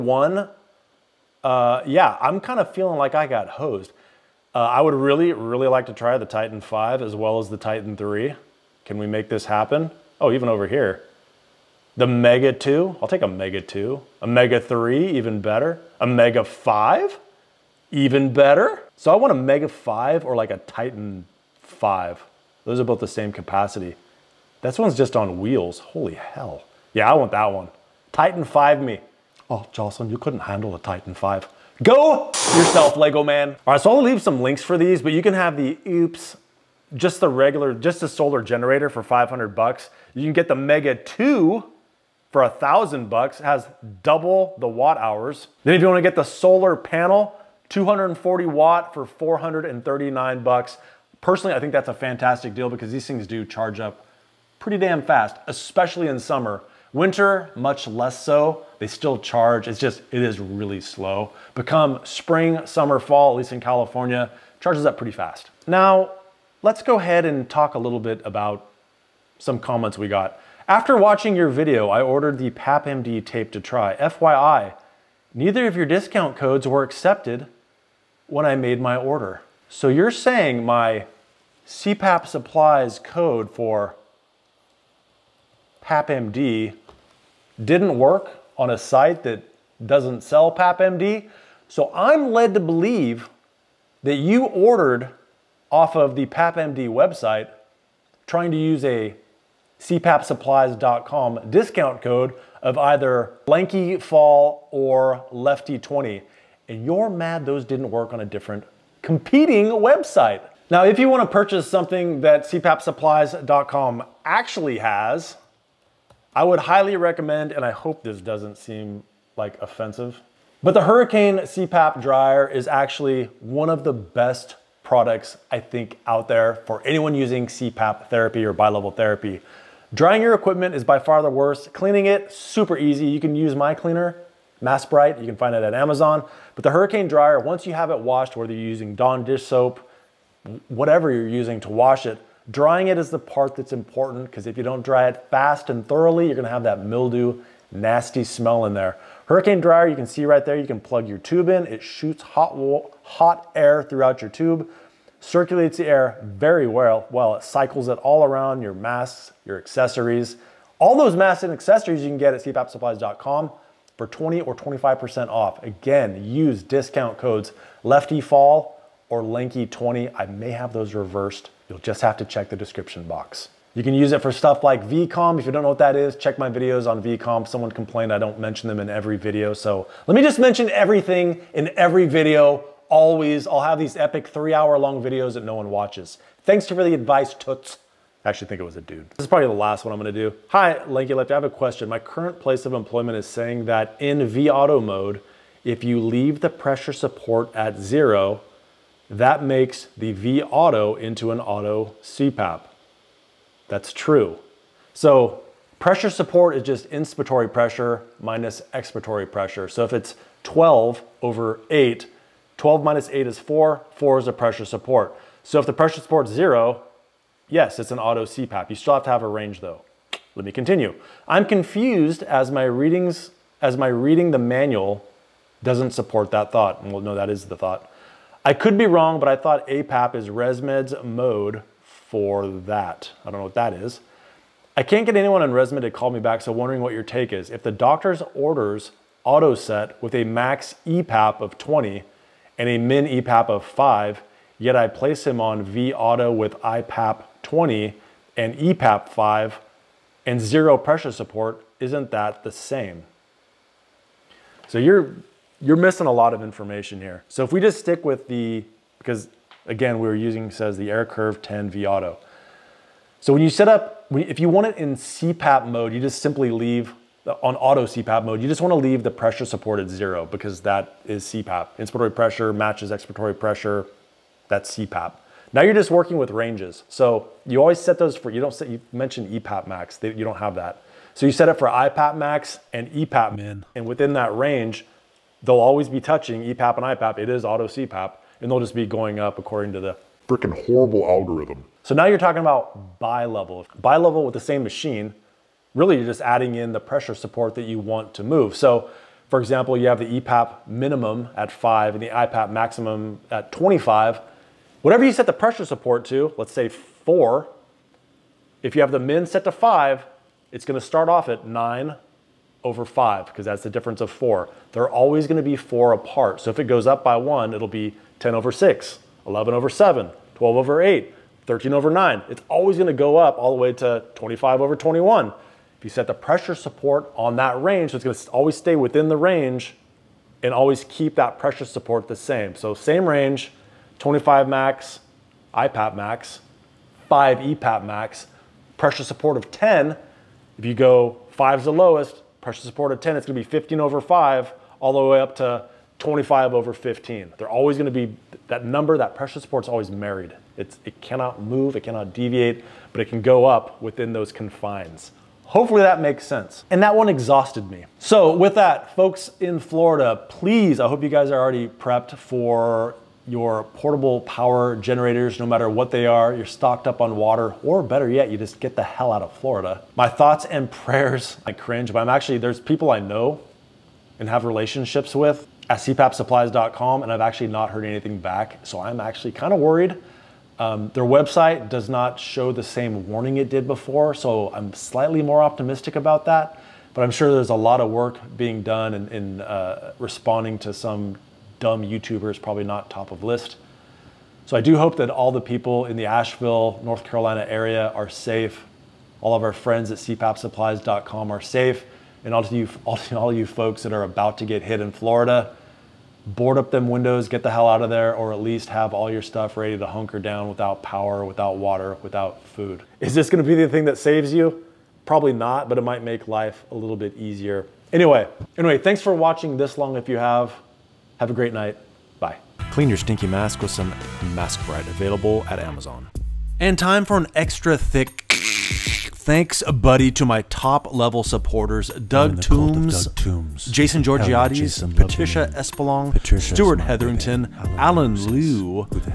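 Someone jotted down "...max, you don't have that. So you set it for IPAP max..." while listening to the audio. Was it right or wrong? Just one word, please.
right.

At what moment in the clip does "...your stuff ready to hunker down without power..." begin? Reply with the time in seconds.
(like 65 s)
409 s.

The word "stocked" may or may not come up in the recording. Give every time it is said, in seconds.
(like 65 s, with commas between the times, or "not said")
366 s.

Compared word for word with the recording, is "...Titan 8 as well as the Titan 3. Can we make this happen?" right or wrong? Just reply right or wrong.
wrong.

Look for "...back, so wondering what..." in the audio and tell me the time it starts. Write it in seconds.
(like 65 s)
236 s.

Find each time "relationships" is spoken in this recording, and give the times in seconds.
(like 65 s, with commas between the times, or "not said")
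374 s.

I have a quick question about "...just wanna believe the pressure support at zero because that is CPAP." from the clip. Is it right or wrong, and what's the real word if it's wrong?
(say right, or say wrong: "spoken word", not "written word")
wrong: "leave", not "believe".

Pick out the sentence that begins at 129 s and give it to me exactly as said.
Drying your equipment is by far the worst.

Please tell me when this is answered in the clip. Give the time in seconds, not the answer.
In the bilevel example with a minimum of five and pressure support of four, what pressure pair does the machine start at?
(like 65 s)
311 s.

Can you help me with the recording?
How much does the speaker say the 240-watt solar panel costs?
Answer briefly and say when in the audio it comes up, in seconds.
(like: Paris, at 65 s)
$439, at 49 s.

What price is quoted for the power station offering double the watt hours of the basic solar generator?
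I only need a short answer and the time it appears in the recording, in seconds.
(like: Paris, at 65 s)
$1,000, at 42 s.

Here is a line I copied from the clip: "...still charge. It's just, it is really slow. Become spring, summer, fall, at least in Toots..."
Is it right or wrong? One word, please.
wrong.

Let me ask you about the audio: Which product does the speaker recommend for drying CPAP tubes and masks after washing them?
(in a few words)
Hurricane CPAP dryer.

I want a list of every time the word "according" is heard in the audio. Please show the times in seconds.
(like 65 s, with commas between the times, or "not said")
289 s.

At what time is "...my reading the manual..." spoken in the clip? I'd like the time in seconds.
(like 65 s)
223 s.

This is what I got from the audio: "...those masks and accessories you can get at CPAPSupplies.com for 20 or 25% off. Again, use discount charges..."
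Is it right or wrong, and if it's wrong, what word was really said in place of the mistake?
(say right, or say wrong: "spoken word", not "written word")
wrong: "codes", not "charges".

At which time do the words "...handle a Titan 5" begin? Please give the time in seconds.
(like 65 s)
30 s.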